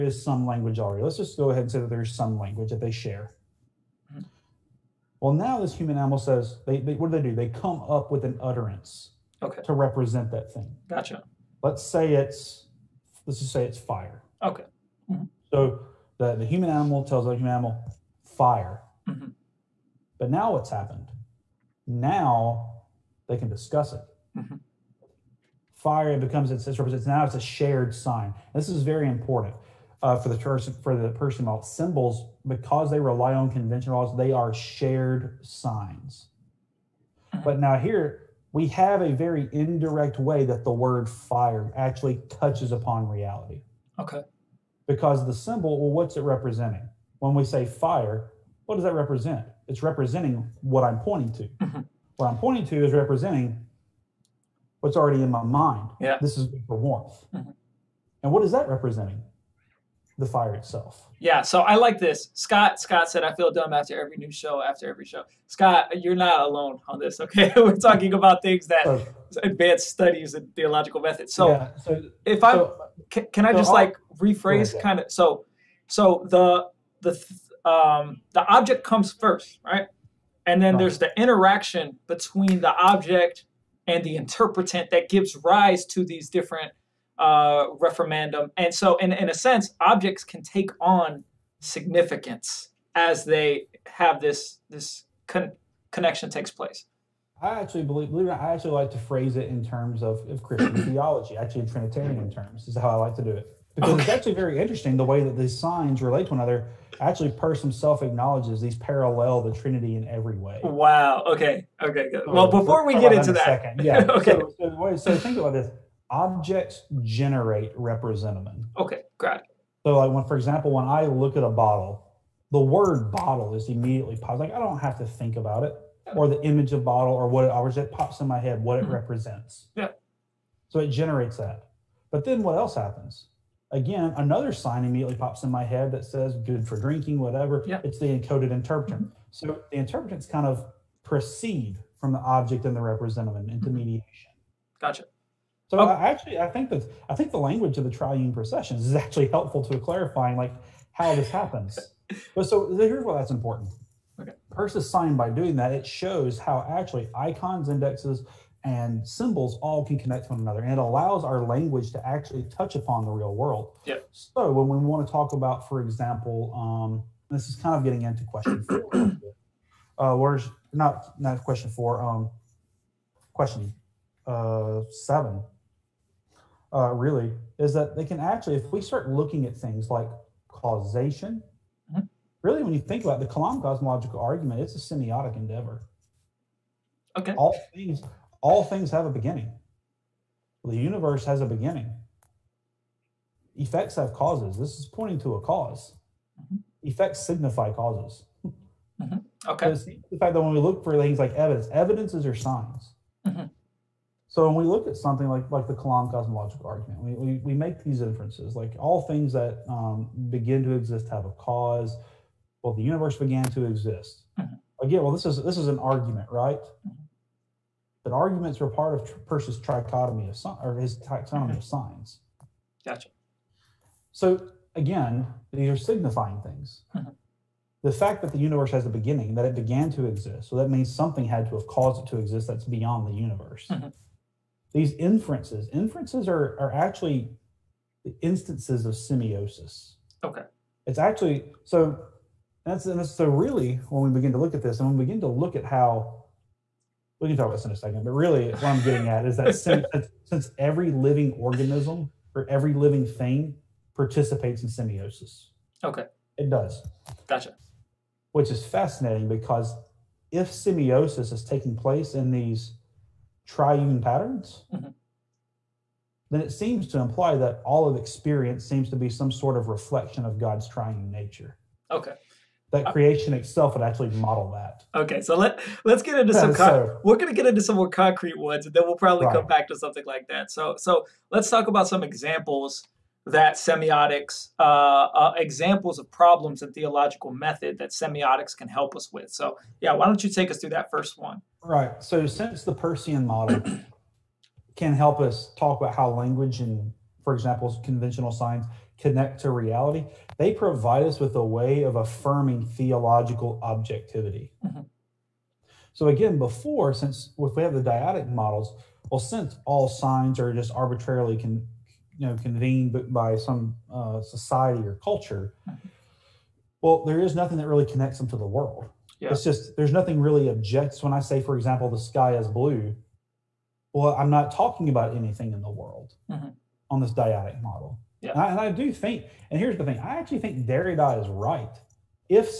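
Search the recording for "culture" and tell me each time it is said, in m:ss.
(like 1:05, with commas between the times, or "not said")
5:15.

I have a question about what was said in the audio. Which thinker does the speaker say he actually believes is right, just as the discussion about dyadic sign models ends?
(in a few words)
Derrida.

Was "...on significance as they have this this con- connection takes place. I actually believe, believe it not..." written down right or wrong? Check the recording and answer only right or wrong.
right.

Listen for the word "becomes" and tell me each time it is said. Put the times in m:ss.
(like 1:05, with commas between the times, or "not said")
0:26.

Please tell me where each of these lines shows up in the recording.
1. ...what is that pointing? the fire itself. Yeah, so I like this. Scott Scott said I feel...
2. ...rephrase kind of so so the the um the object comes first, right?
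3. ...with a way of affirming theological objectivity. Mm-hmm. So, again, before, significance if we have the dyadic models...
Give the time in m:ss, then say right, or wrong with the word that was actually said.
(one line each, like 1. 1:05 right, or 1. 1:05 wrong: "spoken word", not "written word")
1. 0:58 wrong: "representing", not "pointing"
2. 1:14 right
3. 5:01 wrong: "since", not "significance".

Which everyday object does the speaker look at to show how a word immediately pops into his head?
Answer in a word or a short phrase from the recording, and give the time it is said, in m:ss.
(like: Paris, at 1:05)
a bottle, at 2:01.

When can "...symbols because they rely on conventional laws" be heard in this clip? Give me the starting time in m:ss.
0:31.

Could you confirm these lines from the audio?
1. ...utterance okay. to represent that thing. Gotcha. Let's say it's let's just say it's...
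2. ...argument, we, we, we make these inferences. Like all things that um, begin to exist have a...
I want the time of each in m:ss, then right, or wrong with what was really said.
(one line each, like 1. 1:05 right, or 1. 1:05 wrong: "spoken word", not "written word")
1. 0:08 right
2. 3:26 right.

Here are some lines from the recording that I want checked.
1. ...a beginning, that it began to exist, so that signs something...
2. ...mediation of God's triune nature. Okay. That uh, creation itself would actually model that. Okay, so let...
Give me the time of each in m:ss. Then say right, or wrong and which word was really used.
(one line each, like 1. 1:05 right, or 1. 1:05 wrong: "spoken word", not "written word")
1. 3:48 wrong: "means", not "signs"
2. 4:29 wrong: "reflection", not "mediation".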